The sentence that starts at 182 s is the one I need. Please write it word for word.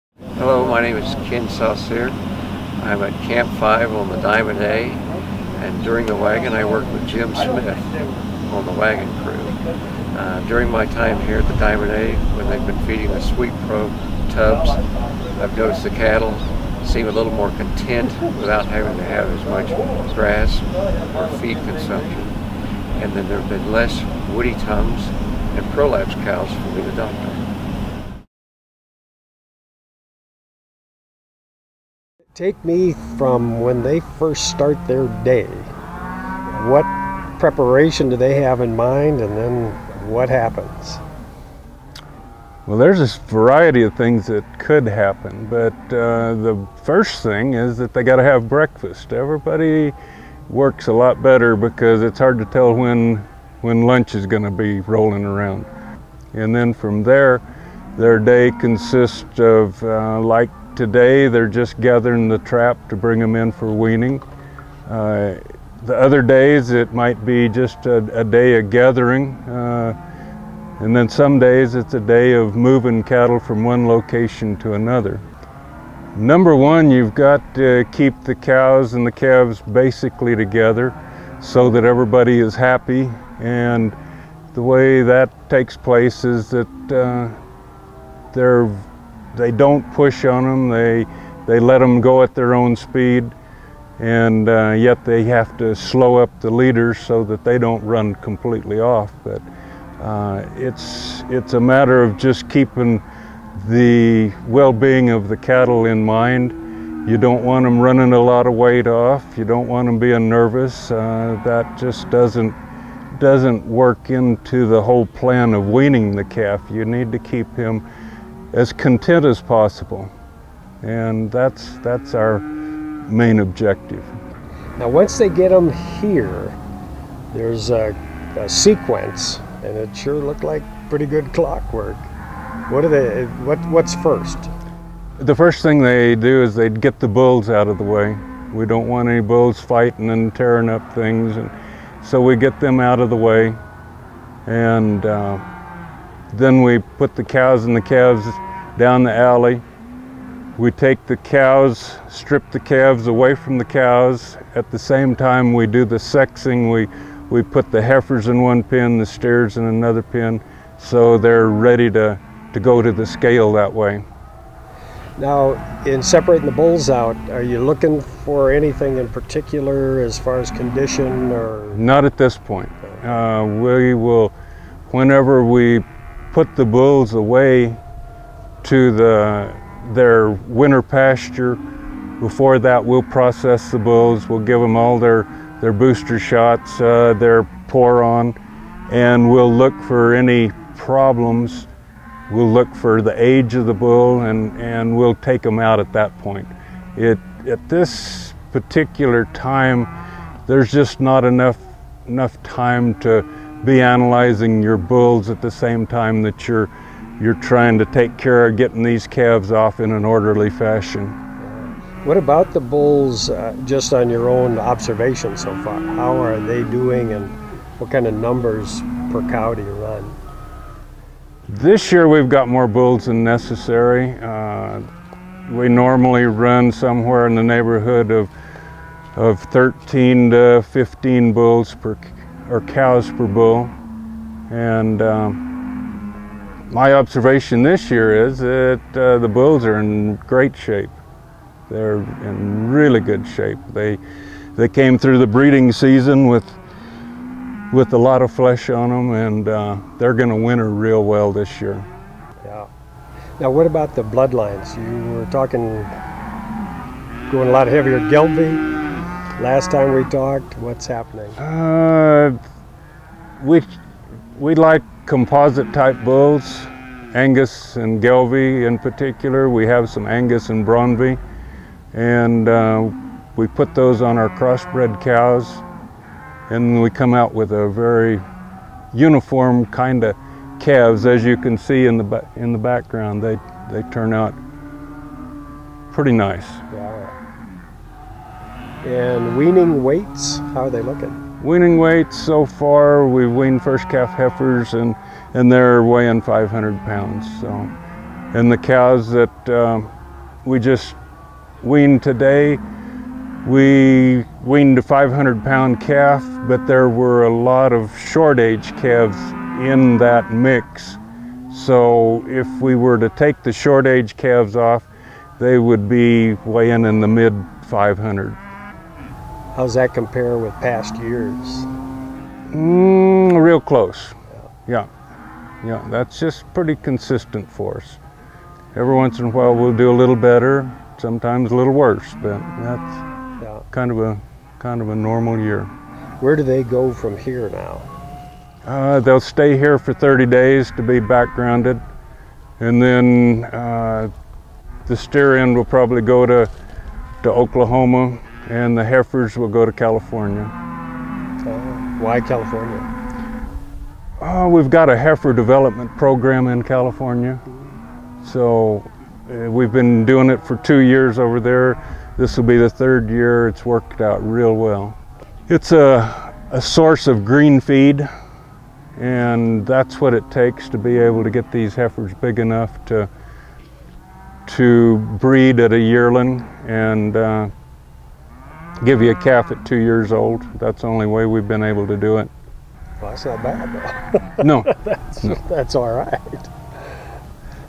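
Before that, we'll process the bulls.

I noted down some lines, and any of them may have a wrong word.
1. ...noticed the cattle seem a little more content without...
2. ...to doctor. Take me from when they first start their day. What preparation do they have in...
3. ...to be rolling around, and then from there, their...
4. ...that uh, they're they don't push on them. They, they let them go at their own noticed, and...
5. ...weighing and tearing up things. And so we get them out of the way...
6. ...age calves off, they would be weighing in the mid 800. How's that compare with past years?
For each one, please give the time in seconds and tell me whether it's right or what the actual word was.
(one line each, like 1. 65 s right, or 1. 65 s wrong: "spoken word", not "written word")
1. 15 s right
2. 26 s right
3. 54 s right
4. 86 s wrong: "speed", not "noticed"
5. 139 s wrong: "fighting", not "weighing"
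6. 313 s wrong: "500", not "800".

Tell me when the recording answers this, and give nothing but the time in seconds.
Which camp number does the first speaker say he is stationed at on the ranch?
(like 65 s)
3 s.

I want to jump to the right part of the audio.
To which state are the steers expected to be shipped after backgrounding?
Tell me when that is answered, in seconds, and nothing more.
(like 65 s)
347 s.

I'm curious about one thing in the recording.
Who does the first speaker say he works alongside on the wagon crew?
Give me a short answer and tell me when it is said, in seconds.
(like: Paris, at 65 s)
Jim Smith, at 7 s.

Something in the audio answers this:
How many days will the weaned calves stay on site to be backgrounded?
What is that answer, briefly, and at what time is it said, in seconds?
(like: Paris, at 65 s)
30, at 339 s.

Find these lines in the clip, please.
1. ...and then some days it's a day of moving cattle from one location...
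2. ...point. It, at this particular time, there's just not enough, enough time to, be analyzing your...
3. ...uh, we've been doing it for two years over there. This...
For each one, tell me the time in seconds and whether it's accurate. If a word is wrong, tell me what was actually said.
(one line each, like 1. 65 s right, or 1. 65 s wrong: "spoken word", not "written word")
1. 70 s right
2. 196 s right
3. 359 s right.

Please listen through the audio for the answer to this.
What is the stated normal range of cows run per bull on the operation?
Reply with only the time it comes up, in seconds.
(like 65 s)
229 s.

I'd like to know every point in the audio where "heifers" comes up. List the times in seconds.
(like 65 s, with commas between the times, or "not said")
157 s, 294 s, 348 s, 354 s, 371 s.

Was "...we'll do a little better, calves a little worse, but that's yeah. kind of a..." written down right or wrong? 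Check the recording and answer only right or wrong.
wrong.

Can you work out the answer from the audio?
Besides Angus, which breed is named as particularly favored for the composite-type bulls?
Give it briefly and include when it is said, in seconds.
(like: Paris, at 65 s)
Gelbvieh, at 268 s.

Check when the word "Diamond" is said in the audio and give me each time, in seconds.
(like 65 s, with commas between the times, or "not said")
4 s, 11 s.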